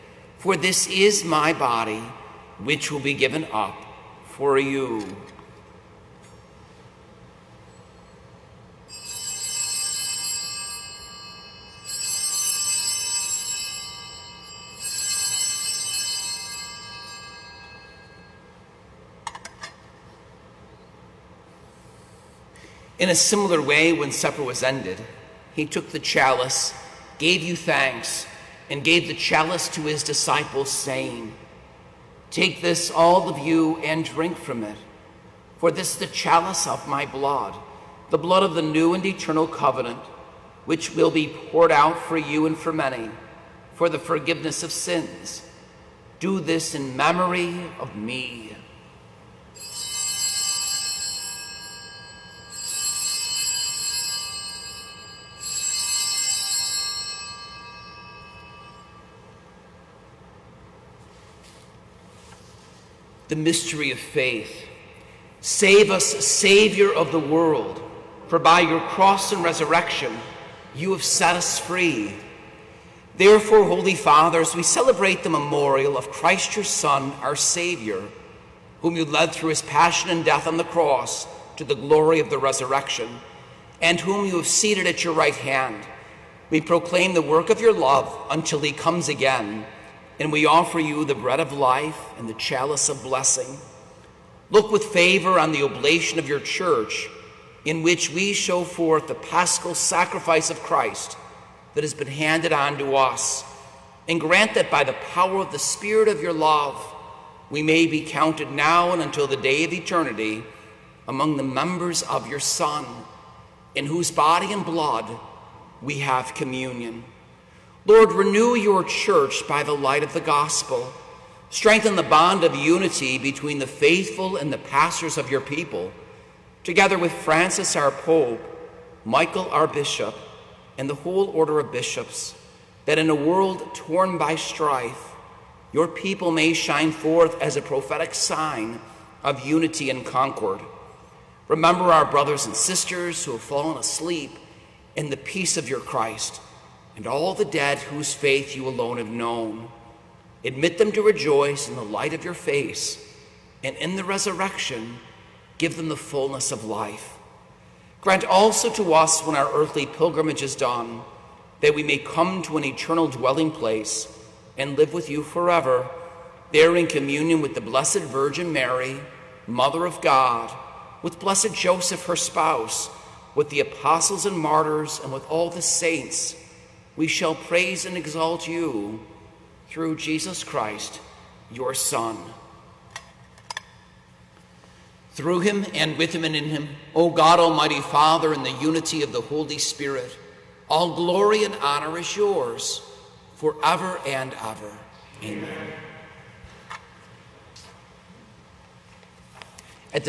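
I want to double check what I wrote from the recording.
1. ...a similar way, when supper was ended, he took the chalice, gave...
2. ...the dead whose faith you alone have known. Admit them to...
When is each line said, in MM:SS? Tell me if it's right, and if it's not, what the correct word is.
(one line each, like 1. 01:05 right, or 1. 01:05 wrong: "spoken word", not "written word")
1. 00:23 right
2. 02:27 right.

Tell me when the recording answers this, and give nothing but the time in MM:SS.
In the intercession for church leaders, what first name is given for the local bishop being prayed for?
02:09.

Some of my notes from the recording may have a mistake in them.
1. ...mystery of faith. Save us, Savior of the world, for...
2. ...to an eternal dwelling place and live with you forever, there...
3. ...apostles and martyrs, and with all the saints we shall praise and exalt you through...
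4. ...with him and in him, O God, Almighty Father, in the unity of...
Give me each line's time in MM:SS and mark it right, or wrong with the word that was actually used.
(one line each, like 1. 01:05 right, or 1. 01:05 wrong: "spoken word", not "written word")
1. 01:03 right
2. 02:42 right
3. 02:53 right
4. 03:05 right.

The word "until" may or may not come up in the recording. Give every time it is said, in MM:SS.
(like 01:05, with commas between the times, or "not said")
01:28, 01:49.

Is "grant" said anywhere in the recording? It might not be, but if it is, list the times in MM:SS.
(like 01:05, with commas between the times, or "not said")
01:44, 02:38.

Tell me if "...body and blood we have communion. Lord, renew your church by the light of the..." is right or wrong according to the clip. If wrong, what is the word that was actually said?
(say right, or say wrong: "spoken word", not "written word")
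right.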